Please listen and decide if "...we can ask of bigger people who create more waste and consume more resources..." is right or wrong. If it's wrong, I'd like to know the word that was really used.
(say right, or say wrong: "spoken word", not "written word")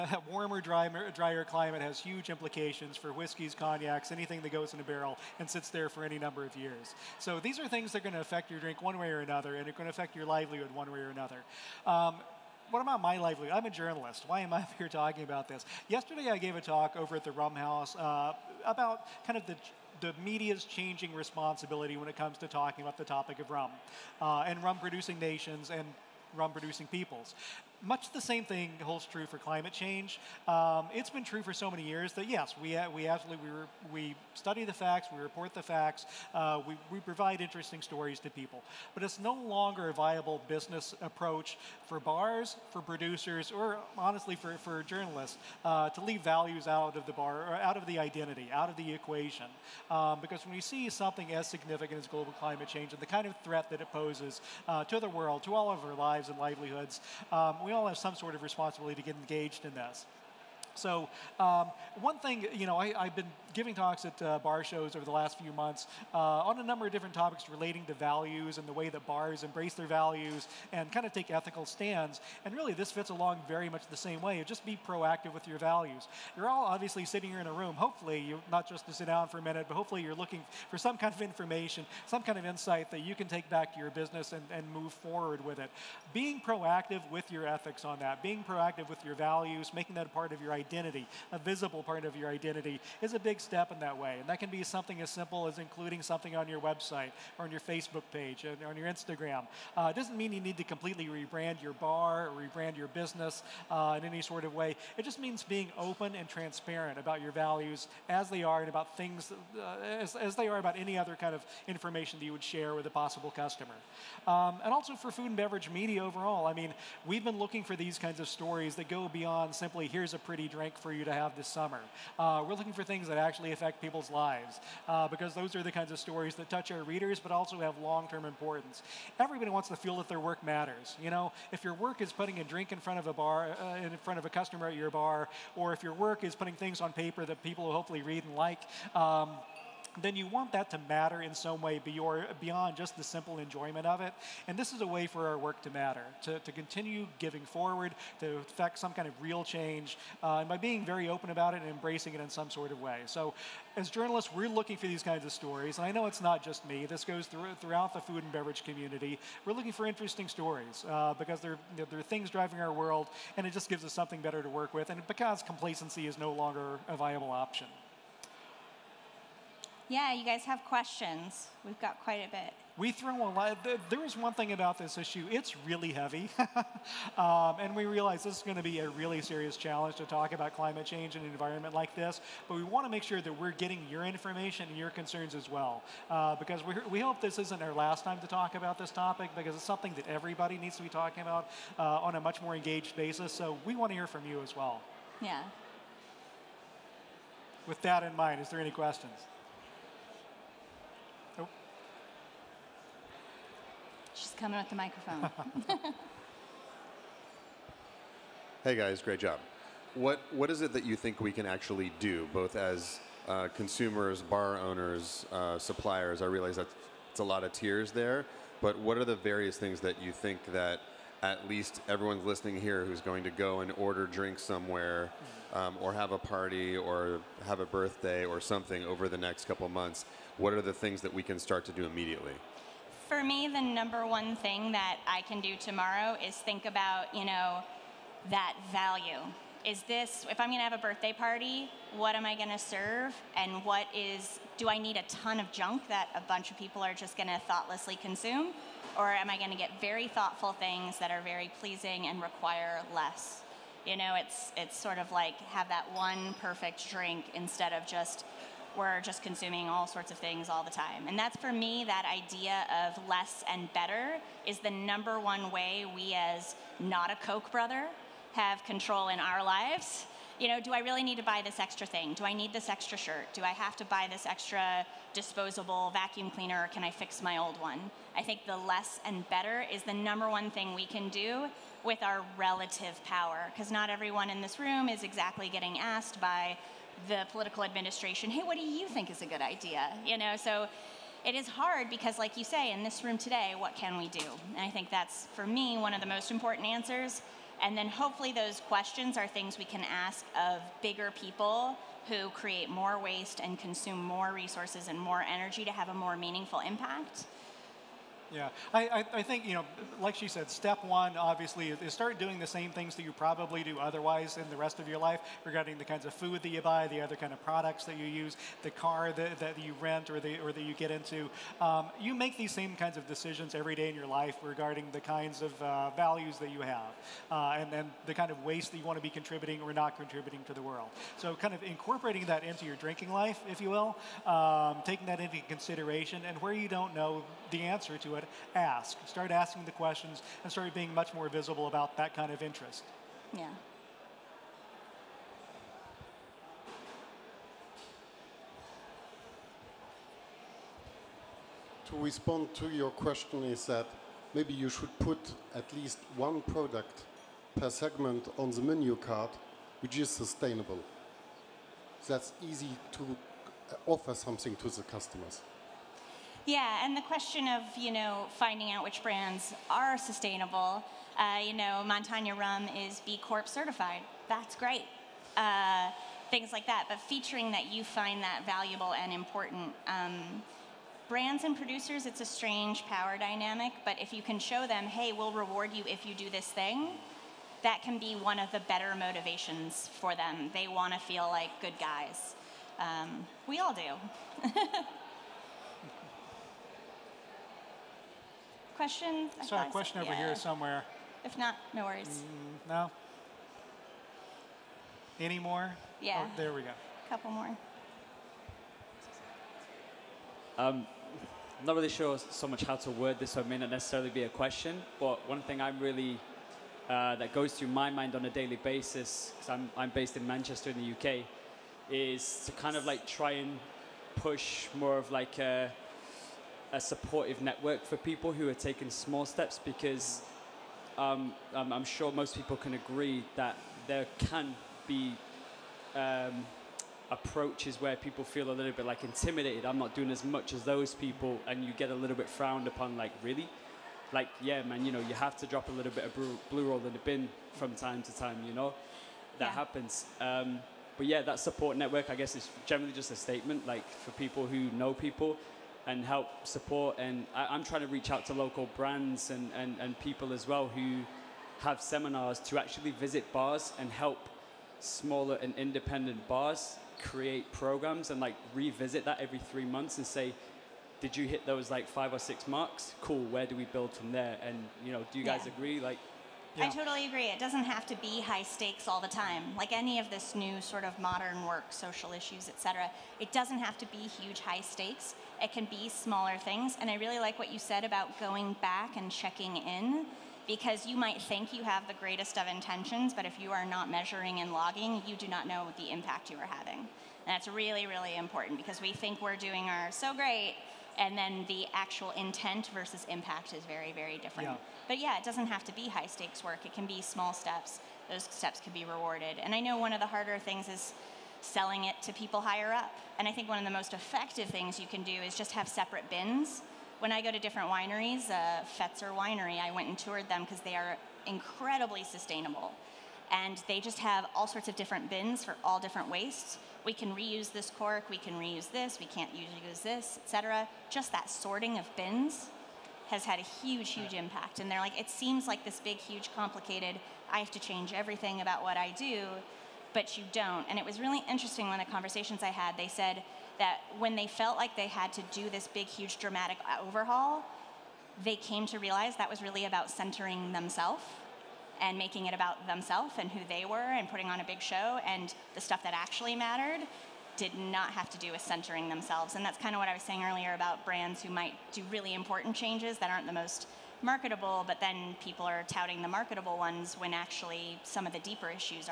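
right.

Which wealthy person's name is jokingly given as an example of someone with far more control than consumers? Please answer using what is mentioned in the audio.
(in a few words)
Koch brother.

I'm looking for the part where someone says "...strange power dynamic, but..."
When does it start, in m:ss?
6:22.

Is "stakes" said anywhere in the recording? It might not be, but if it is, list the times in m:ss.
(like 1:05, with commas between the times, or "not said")
7:58, 8:04, 8:26.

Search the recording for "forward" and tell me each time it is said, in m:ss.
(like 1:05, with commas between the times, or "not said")
1:24, 2:27.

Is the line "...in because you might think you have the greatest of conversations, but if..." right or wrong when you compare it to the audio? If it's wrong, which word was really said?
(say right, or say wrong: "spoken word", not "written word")
wrong: "intentions", not "conversations".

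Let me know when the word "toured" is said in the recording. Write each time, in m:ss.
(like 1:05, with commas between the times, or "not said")
8:39.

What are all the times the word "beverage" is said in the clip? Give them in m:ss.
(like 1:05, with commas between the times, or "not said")
1:55, 2:38.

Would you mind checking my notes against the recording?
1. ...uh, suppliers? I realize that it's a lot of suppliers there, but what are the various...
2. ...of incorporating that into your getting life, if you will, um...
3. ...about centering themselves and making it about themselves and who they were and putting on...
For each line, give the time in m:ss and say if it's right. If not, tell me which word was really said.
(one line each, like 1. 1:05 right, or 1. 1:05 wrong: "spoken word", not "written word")
1. 3:35 wrong: "tiers", not "suppliers"
2. 5:31 wrong: "drinking", not "getting"
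3. 9:09 right.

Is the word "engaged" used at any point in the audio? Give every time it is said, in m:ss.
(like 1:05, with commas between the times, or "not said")
0:59, 3:12.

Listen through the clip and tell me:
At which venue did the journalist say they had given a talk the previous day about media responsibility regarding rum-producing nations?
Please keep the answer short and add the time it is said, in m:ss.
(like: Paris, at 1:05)
Rum House, at 0:17.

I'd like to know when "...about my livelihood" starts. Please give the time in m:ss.
0:12.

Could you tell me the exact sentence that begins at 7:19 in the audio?
I'm not doing as much as those people, and you get a little bit frowned upon.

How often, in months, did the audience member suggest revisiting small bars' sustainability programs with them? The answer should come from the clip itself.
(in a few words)
3.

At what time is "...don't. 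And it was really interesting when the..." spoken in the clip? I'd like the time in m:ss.
9:00.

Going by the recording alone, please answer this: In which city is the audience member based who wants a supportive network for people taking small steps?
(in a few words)
Manchester.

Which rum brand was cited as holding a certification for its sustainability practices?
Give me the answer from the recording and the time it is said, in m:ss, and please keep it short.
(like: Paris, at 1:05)
Montanya Rum, at 6:11.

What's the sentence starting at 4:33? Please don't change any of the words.
Do I have to buy this extra disposable vacuum cleaner or can I fix my old one?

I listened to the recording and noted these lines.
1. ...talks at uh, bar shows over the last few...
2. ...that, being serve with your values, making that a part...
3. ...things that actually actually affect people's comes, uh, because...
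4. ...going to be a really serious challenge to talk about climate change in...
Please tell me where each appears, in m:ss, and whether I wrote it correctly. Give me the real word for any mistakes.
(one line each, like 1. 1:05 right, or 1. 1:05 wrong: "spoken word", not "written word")
1. 1:03 right
2. 1:27 wrong: "proactive", not "serve"
3. 2:02 wrong: "lives", not "comes"
4. 2:58 right.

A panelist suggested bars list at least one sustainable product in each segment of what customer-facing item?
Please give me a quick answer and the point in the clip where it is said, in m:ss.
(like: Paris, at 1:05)
menu card, at 5:58.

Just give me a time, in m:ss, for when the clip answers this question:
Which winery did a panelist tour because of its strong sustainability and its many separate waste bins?
8:38.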